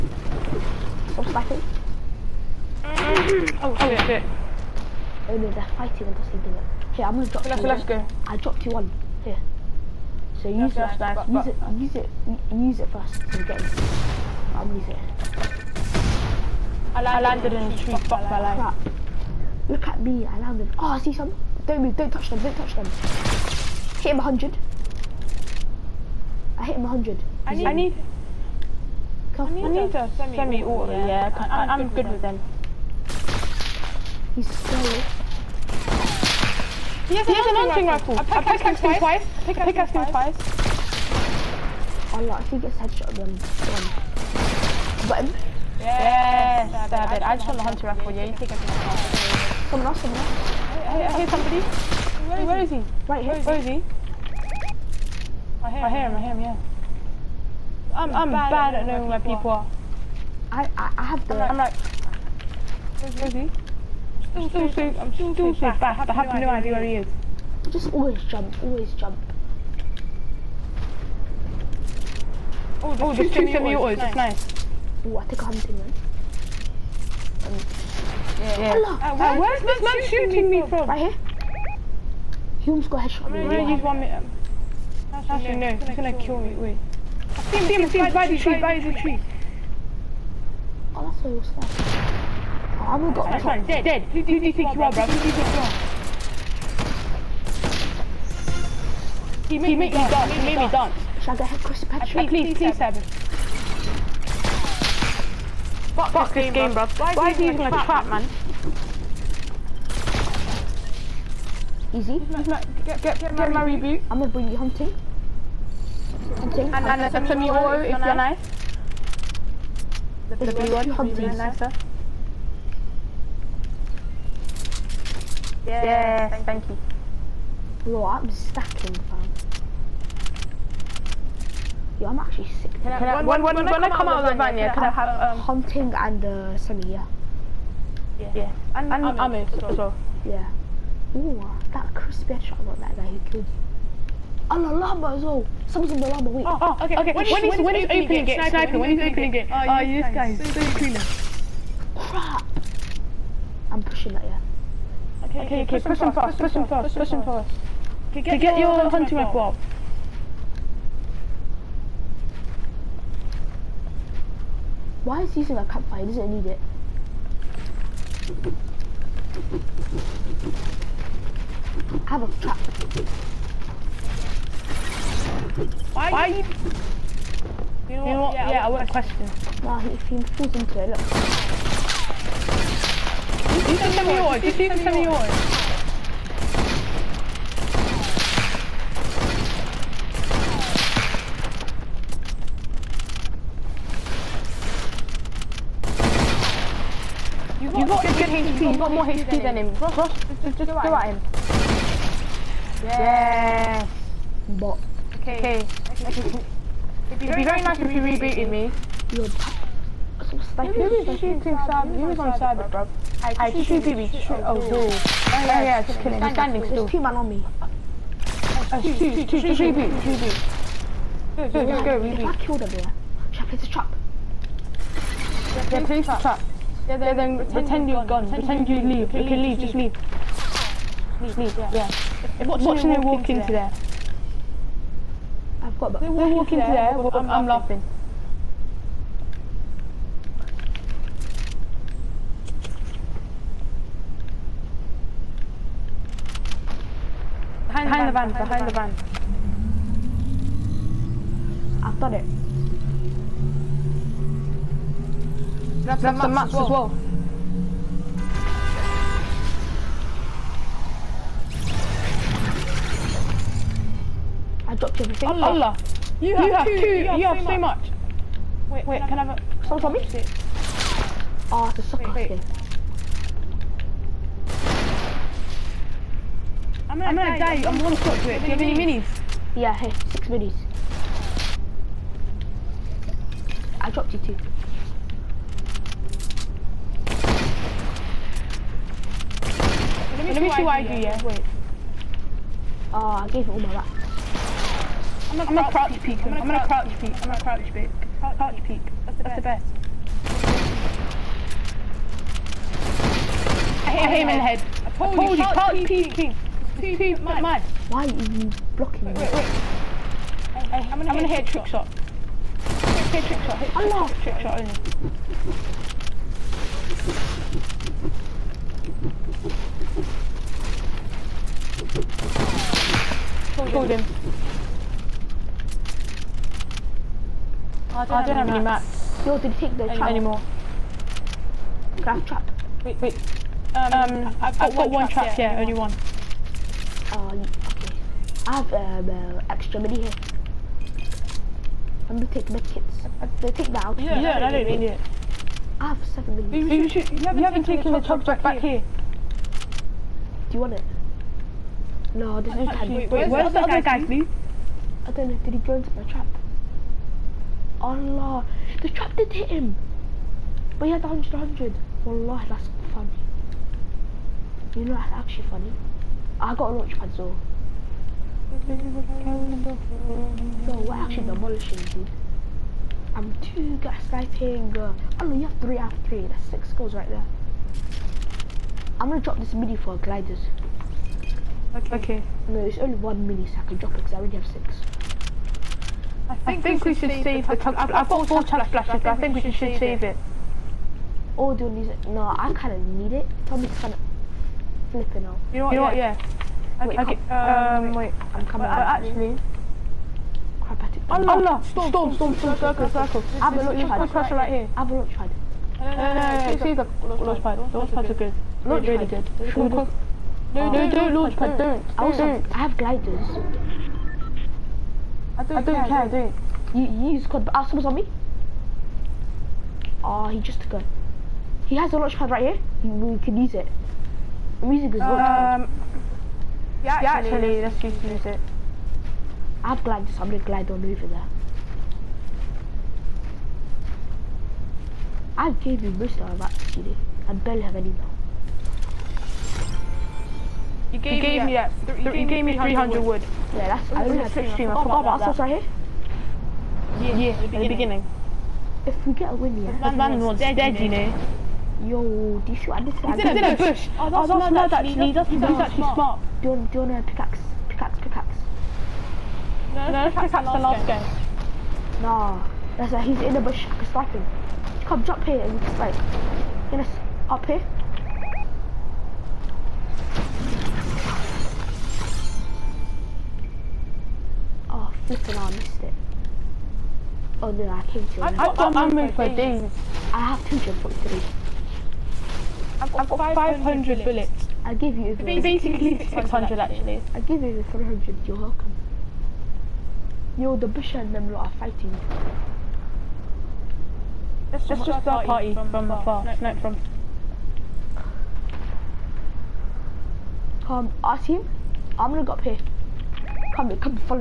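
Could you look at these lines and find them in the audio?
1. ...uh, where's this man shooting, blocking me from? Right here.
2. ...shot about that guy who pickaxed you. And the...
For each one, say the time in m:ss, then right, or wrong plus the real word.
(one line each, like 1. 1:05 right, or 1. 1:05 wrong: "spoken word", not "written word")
1. 1:19 wrong: "shooting", not "blocking"
2. 2:22 wrong: "killed", not "pickaxed".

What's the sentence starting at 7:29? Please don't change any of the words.
That man was dead, you know.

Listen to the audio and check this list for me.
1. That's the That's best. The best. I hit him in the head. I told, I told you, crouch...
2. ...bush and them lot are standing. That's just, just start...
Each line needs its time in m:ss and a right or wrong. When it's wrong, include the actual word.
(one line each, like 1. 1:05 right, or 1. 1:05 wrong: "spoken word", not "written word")
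1. 4:59 right
2. 8:10 wrong: "fighting", not "standing".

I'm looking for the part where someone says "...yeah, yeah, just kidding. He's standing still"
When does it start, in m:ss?
3:35.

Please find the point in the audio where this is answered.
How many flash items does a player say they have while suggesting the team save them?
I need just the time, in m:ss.
6:28.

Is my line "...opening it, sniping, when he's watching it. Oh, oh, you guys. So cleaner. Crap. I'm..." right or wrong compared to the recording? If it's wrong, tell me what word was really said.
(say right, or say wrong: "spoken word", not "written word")
wrong: "opening", not "watching".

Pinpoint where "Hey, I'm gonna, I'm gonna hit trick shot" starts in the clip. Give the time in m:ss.
5:10.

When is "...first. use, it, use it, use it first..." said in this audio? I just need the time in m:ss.
0:10.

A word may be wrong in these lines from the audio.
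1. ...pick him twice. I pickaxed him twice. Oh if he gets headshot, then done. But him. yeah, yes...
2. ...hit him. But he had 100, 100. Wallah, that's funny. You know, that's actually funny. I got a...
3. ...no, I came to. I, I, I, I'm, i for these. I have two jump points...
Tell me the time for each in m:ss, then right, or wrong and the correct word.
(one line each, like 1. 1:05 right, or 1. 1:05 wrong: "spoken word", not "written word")
1. 0:38 right
2. 5:59 right
3. 7:57 right.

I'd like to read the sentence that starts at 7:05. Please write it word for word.
Um, yeah, actually, yeah, actually let's just use it.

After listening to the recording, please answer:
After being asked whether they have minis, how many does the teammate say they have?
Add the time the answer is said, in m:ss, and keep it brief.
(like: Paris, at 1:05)
6, at 4:40.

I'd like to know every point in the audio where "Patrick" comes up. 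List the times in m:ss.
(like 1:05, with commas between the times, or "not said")
1:41.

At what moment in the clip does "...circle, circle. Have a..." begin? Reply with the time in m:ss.
6:42.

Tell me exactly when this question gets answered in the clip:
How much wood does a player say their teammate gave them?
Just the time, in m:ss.
7:22.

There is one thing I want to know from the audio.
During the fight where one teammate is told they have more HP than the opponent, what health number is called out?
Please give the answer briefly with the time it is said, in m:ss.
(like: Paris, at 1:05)
58, at 3:03.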